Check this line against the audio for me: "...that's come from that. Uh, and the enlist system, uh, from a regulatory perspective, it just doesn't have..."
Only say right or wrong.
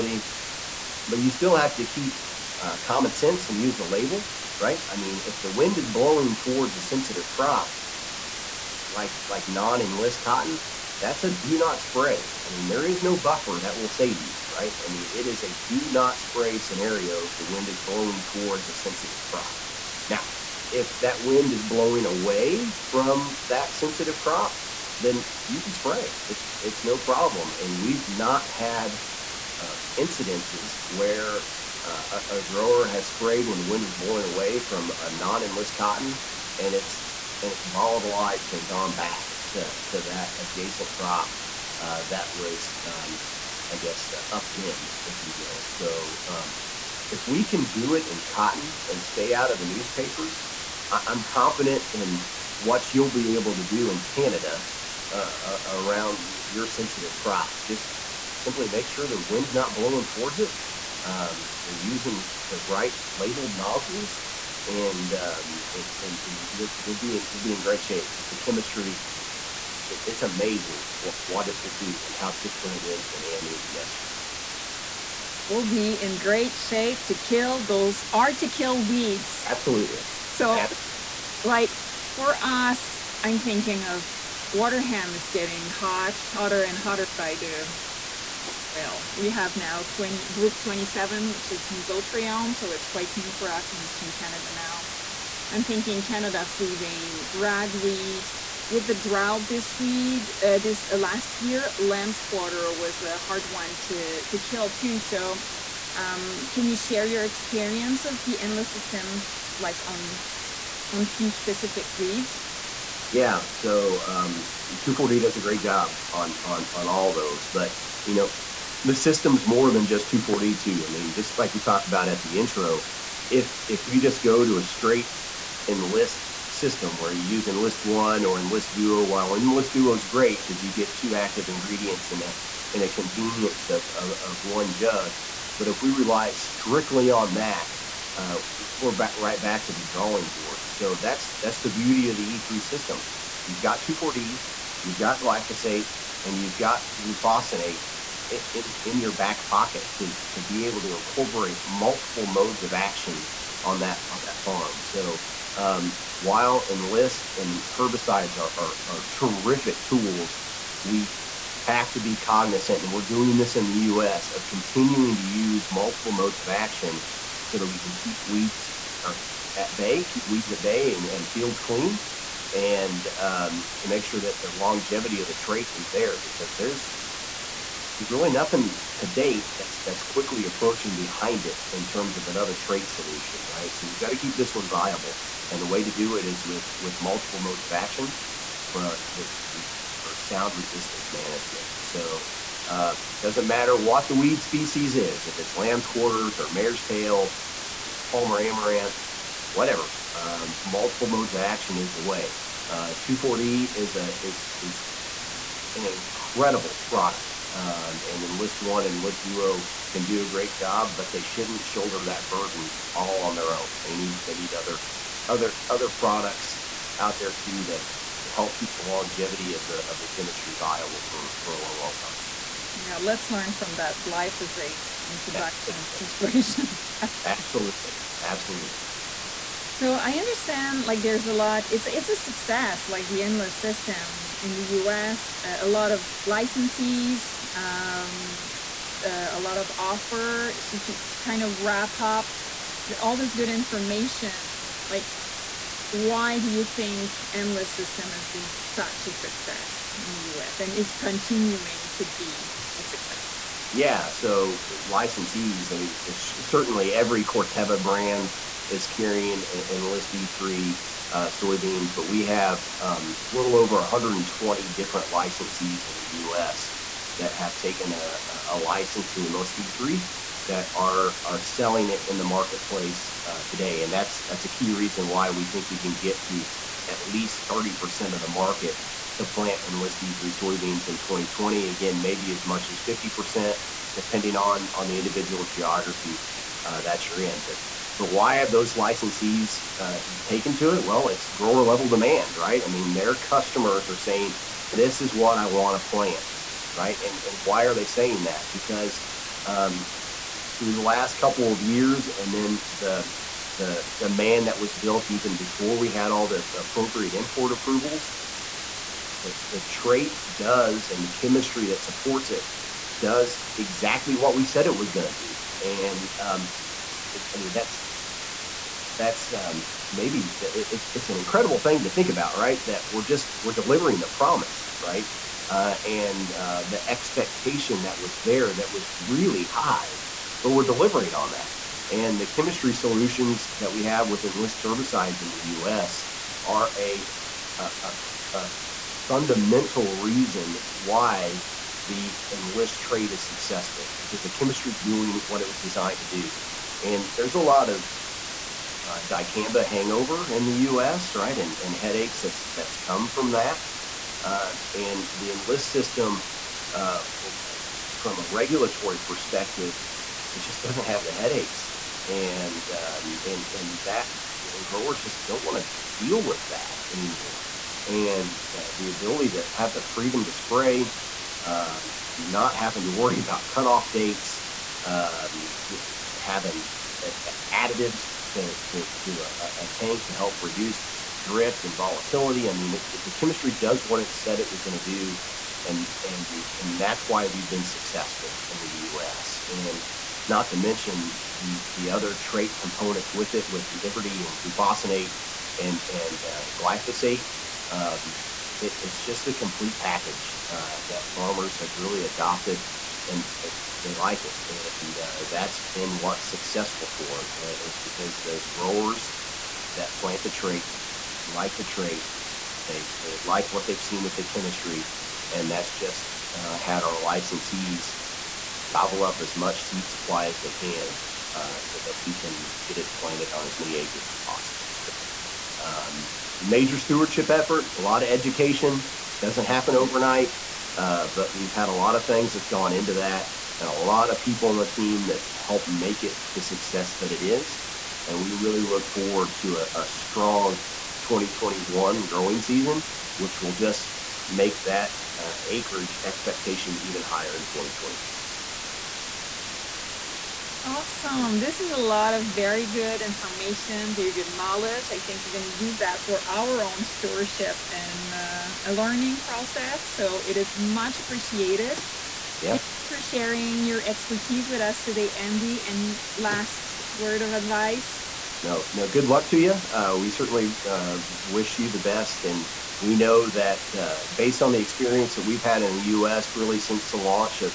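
right.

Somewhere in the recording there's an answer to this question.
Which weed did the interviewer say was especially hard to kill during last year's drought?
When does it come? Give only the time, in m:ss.
1:41.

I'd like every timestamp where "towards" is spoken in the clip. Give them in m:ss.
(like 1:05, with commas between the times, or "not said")
0:06, 0:18, 1:00.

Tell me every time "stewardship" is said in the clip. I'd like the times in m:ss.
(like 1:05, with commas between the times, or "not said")
7:06, 7:36.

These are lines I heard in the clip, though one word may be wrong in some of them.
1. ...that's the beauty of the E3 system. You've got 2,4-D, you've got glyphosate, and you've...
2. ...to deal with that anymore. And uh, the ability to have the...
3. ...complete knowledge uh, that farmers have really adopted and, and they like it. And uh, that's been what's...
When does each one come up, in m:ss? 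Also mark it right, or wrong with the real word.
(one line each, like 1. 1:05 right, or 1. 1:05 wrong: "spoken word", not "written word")
1. 2:21 right
2. 6:05 right
3. 6:39 wrong: "package", not "knowledge".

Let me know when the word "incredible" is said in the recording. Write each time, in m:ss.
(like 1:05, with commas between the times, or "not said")
3:25, 5:21.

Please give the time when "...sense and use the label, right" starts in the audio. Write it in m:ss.
0:03.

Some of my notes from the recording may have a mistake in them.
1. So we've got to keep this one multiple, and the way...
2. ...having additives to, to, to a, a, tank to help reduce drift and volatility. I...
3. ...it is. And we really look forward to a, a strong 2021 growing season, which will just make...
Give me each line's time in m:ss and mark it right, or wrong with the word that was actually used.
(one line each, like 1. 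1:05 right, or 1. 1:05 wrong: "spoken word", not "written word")
1. 3:03 wrong: "viable", not "multiple"
2. 6:16 right
3. 7:17 right.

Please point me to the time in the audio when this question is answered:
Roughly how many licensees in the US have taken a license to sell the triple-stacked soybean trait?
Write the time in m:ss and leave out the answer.
4:23.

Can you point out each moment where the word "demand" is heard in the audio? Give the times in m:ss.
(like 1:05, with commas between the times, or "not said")
4:51, 5:03.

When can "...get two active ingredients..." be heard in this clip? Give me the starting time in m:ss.
2:10.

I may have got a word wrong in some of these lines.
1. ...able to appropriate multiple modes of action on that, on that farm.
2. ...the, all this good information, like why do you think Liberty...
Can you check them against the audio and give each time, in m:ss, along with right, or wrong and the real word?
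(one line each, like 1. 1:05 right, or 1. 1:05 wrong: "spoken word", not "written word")
1. 2:30 wrong: "incorporate", not "appropriate"
2. 4:02 wrong: "Enlist", not "Liberty".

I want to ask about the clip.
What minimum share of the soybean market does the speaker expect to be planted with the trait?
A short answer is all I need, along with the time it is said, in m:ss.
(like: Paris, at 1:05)
30%, at 4:37.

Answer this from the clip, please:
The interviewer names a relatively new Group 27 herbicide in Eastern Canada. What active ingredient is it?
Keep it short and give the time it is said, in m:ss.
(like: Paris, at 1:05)
mesotrione, at 1:31.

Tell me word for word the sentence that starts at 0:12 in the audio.
I mean, there is no buffer that will save you, right?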